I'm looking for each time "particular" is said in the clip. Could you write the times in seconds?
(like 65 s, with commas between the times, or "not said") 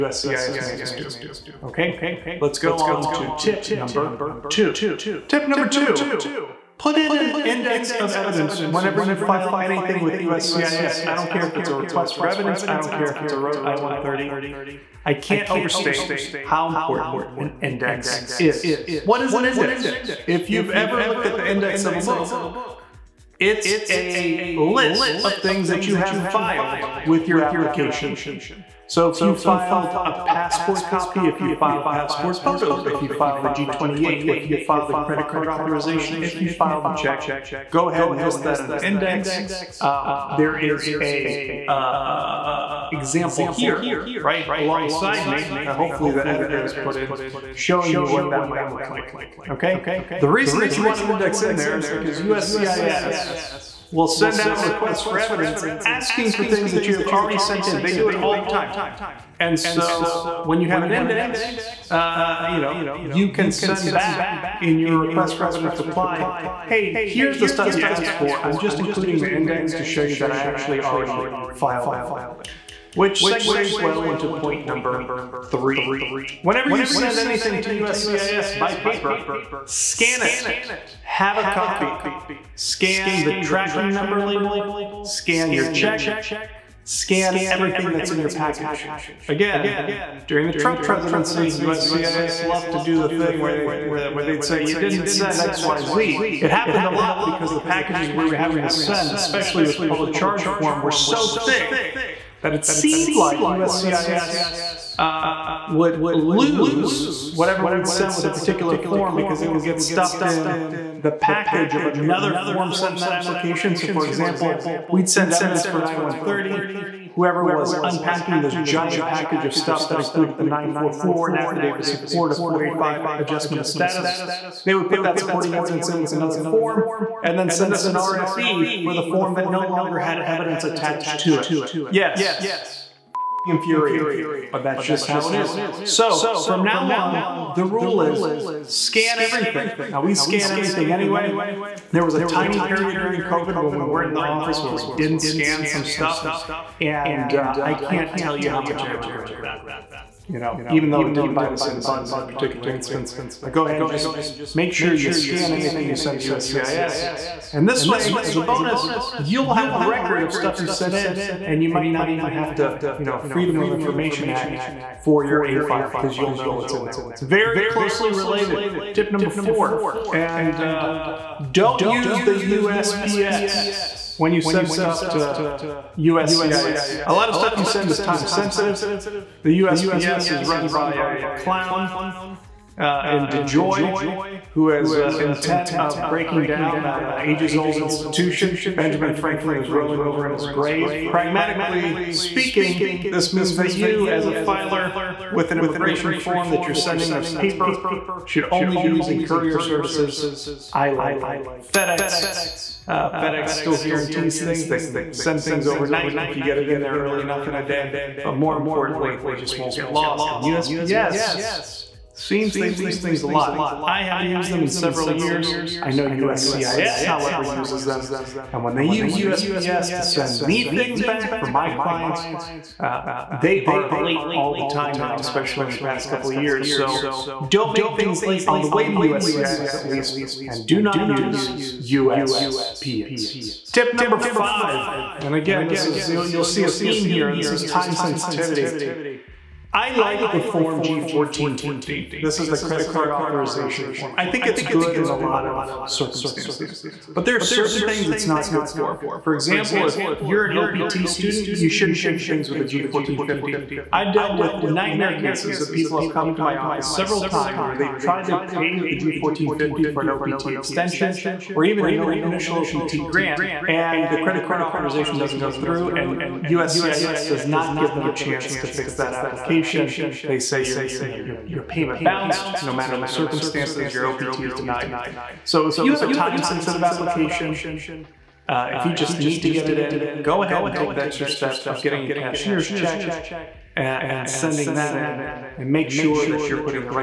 108 s, 152 s.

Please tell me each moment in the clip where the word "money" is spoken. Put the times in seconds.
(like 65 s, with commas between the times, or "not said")
not said.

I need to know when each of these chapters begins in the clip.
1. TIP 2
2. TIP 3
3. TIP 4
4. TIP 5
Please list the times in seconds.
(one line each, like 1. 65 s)
1. 5 s
2. 75 s
3. 170 s
4. 233 s.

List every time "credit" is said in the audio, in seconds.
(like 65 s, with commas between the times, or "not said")
34 s, 242 s, 264 s.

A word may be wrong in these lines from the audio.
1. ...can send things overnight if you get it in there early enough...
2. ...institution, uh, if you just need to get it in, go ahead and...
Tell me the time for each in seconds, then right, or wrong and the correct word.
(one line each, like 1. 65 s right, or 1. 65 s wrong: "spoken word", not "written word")
1. 204 s right
2. 276 s wrong: "application", not "institution".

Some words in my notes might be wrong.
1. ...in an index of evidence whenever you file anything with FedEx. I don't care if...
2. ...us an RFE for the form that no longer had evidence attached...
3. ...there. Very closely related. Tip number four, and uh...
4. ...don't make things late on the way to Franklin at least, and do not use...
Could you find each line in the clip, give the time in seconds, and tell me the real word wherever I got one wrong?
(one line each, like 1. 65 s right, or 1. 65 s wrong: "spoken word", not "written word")
1. 6 s wrong: "USCIS", not "FedEx"
2. 127 s right
3. 166 s right
4. 227 s wrong: "USCIS", not "Franklin".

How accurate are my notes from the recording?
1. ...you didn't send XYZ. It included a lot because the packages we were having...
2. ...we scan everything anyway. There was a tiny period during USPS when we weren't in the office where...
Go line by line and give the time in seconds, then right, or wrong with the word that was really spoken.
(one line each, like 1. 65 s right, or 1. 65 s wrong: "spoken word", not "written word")
1. 94 s wrong: "happened", not "included"
2. 140 s wrong: "COVID", not "USPS".